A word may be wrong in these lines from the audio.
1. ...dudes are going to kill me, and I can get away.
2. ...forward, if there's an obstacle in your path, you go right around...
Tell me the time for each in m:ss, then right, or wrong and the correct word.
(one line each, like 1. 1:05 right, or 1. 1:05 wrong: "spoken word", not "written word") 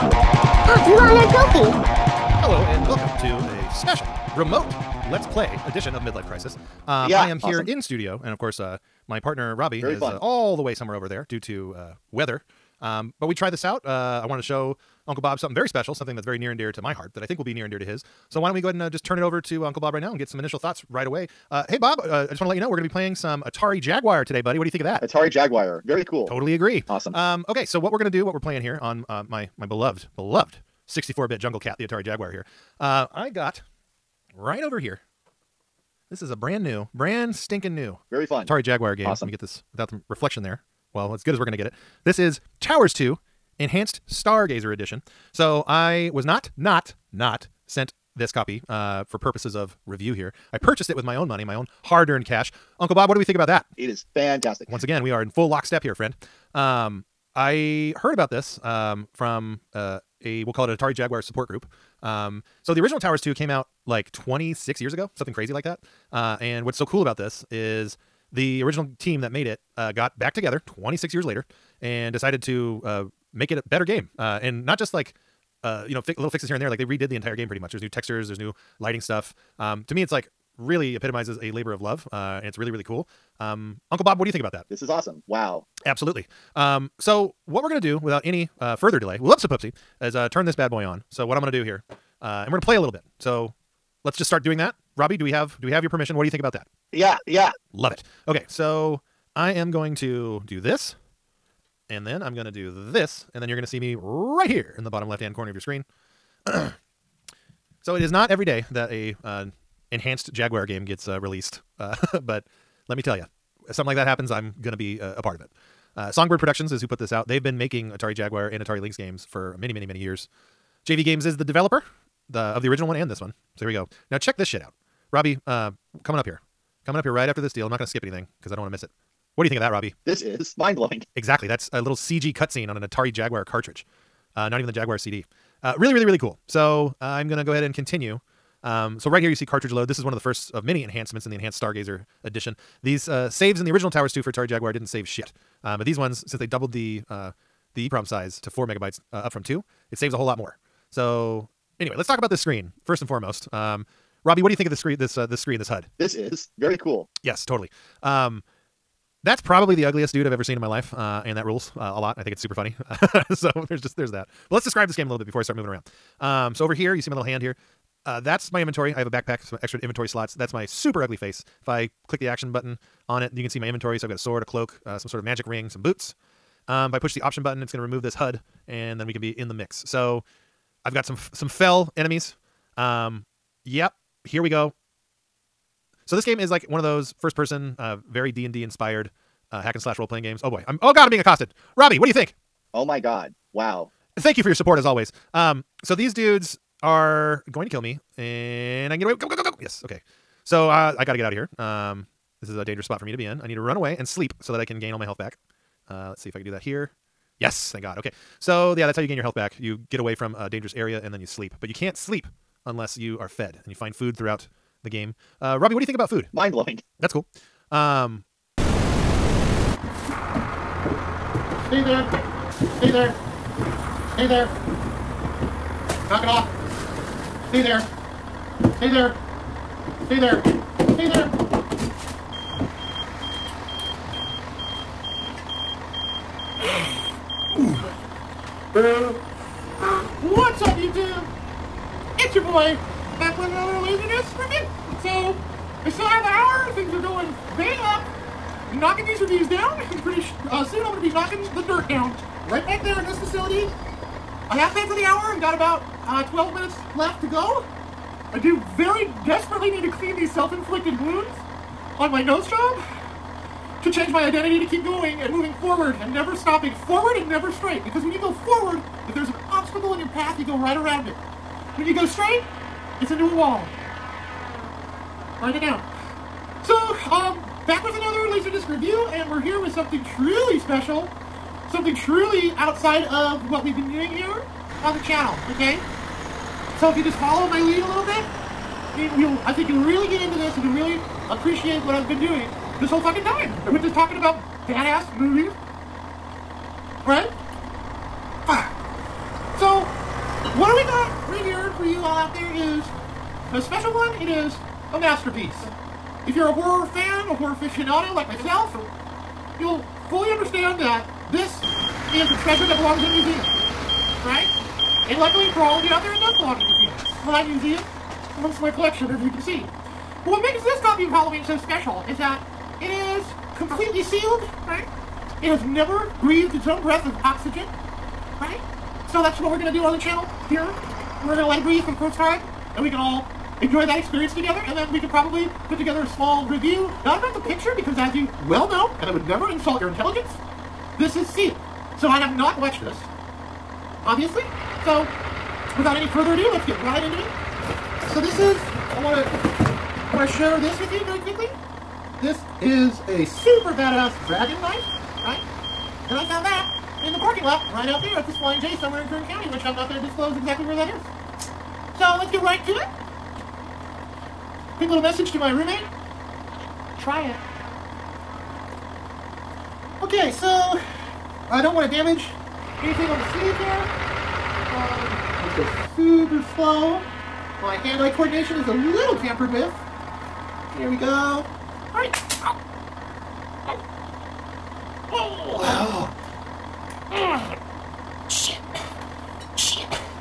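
1. 3:16 right
2. 4:28 right.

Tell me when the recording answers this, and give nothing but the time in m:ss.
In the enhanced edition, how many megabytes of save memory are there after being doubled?
2:28.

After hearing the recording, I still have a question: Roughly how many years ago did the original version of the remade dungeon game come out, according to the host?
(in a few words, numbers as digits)
26.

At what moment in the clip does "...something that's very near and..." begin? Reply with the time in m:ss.
0:15.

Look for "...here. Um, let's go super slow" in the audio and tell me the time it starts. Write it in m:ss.
6:13.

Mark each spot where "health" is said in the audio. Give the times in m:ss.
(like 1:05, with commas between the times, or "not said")
3:25, 3:29.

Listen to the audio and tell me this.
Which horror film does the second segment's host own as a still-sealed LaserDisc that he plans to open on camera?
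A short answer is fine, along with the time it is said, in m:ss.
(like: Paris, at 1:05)
Halloween, at 5:21.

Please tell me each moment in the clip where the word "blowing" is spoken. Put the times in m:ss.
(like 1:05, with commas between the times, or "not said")
2:10, 3:36.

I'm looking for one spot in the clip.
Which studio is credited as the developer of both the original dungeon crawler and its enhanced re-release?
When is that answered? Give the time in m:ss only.
2:00.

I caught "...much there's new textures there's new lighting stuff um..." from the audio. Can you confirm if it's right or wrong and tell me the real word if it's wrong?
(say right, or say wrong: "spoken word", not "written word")
right.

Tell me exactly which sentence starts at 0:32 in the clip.
I got right over here this is a brand new, brand stinking new.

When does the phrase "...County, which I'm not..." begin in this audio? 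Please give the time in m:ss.
5:59.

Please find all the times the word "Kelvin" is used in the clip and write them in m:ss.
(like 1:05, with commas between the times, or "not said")
not said.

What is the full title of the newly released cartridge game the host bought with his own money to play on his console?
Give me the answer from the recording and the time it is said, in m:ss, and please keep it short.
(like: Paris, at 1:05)
Towers 2 Enhanced Stargazer Edition, at 0:42.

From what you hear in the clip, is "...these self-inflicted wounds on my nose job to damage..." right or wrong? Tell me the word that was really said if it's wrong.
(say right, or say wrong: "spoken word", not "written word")
wrong: "change", not "damage".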